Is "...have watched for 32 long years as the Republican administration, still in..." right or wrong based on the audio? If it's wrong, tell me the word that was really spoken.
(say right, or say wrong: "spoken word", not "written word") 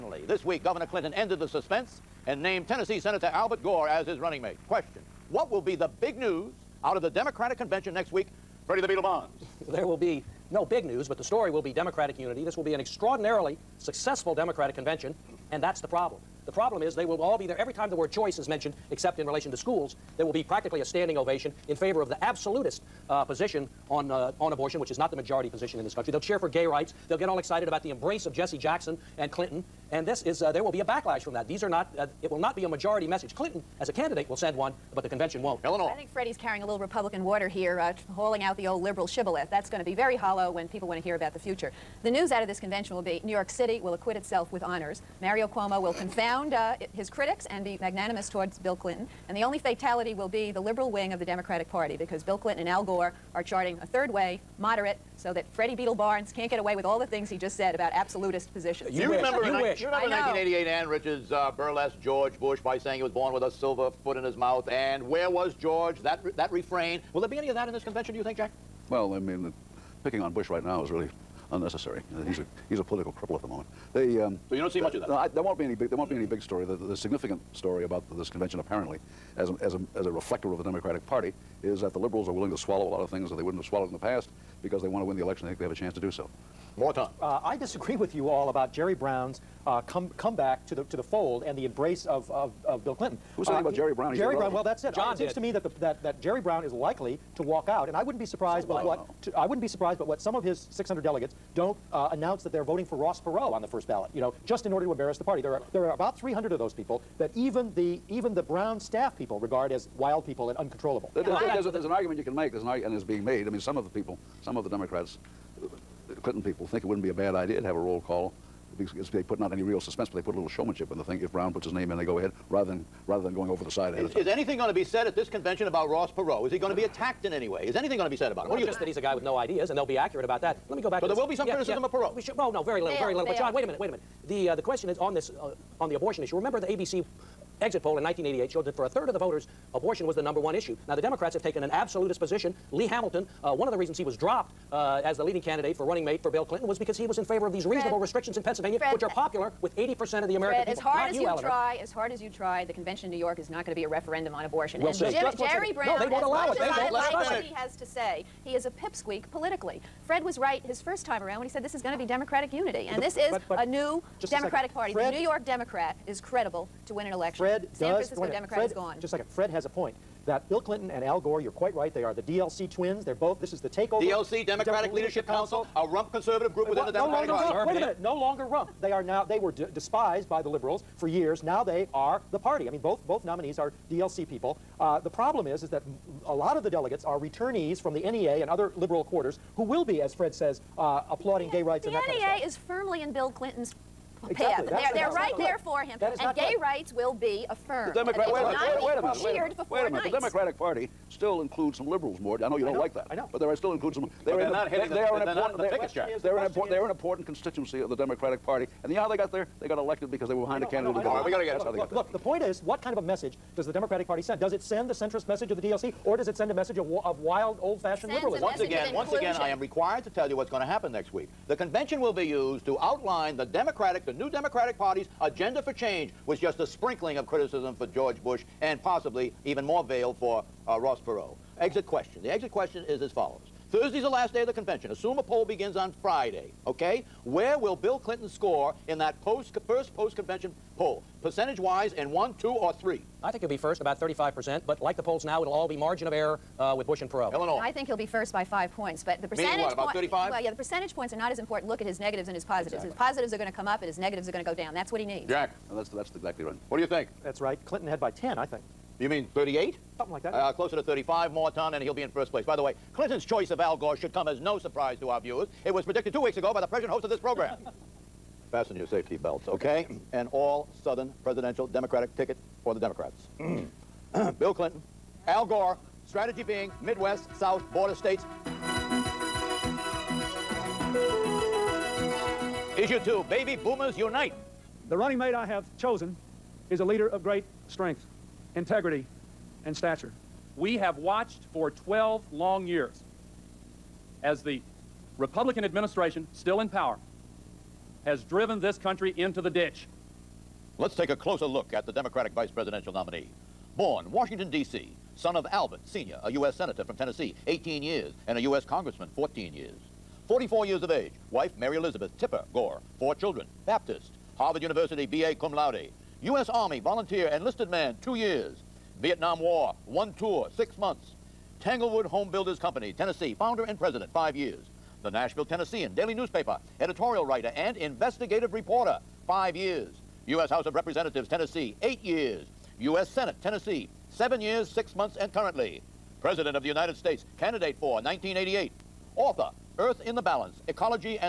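wrong: "12", not "32".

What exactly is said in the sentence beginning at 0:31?
These are not, uh, it will not be a majority message.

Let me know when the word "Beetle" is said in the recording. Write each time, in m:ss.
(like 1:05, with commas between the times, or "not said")
0:08, 0:55.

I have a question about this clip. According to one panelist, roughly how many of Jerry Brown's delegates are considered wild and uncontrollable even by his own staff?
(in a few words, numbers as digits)
300.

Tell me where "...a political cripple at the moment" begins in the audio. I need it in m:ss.
1:12.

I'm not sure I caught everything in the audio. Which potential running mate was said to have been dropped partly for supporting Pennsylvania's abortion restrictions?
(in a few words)
Lee Hamilton.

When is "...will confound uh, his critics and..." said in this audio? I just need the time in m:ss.
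0:45.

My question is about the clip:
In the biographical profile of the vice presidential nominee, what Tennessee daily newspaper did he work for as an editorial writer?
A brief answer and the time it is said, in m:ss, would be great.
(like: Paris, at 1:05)
The Nashville Tennessean, at 5:25.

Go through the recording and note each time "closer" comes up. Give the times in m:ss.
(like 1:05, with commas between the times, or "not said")
4:20, 5:01.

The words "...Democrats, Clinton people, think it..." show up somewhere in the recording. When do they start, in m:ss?
1:54.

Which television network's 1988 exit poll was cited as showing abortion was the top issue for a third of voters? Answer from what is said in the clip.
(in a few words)
ABC.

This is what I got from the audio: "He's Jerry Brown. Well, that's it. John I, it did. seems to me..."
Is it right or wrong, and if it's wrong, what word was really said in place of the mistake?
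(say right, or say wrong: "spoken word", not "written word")
right.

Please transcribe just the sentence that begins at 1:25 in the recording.
They think they have a chance to do so.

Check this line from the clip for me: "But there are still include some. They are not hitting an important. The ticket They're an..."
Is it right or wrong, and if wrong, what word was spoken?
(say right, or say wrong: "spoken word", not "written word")
right.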